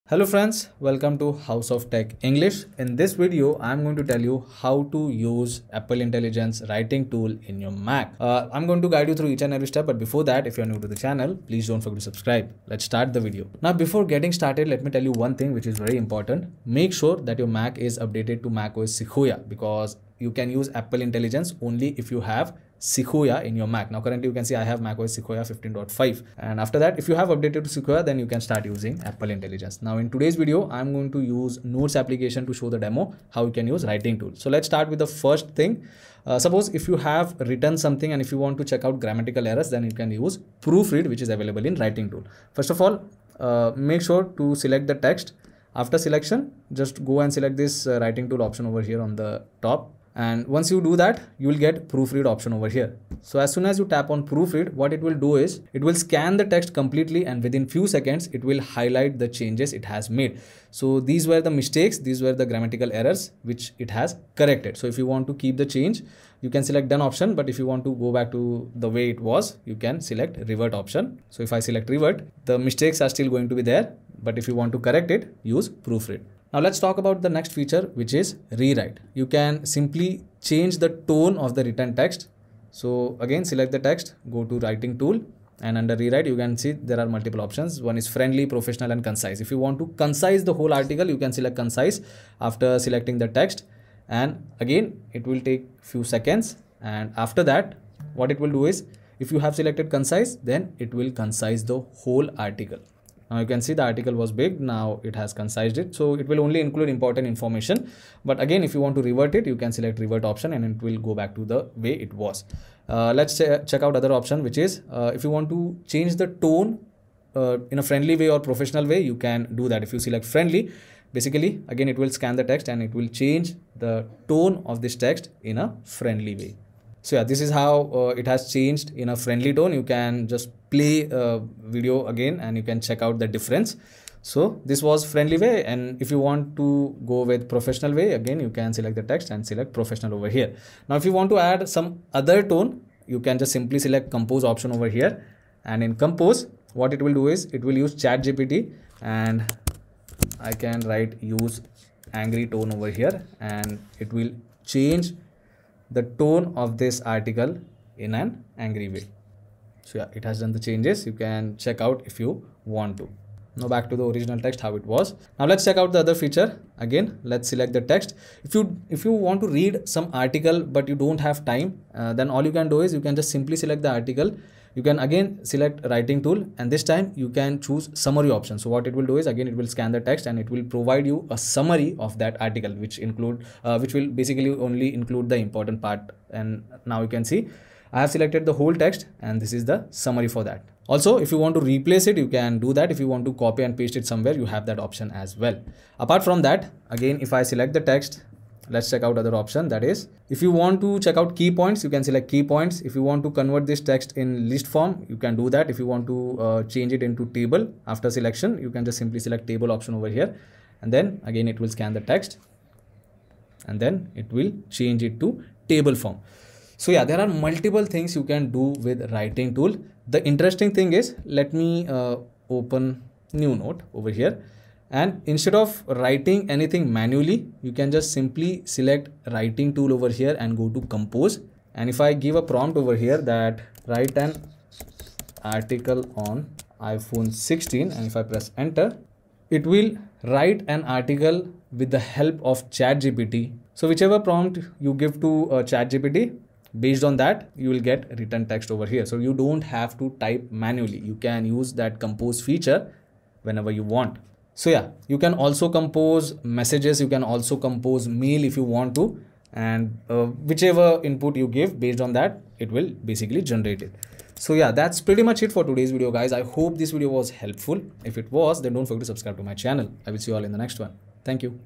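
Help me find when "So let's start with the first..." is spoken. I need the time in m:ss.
0:34.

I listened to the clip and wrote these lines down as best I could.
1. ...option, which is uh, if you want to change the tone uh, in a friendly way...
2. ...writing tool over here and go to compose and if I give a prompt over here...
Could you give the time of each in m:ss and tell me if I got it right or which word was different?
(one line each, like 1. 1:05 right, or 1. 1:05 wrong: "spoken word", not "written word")
1. 1:54 right
2. 3:49 right.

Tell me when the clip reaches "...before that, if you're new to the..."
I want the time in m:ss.
0:09.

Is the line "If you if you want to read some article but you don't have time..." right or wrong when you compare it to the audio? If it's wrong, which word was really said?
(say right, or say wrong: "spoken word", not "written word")
right.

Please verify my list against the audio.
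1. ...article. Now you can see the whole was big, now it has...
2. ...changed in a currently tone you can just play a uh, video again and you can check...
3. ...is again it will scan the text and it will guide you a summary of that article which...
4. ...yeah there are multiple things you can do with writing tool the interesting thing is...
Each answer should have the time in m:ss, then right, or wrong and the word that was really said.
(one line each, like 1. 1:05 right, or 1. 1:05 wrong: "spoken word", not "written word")
1. 1:42 wrong: "article", not "whole"
2. 2:08 wrong: "friendly", not "currently"
3. 2:59 wrong: "provide", not "guide"
4. 3:36 right.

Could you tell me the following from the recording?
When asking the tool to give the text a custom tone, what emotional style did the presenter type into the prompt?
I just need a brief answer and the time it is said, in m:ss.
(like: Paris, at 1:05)
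angry tone, at 2:32.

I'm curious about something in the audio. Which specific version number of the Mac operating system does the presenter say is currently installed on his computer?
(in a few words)
15.5.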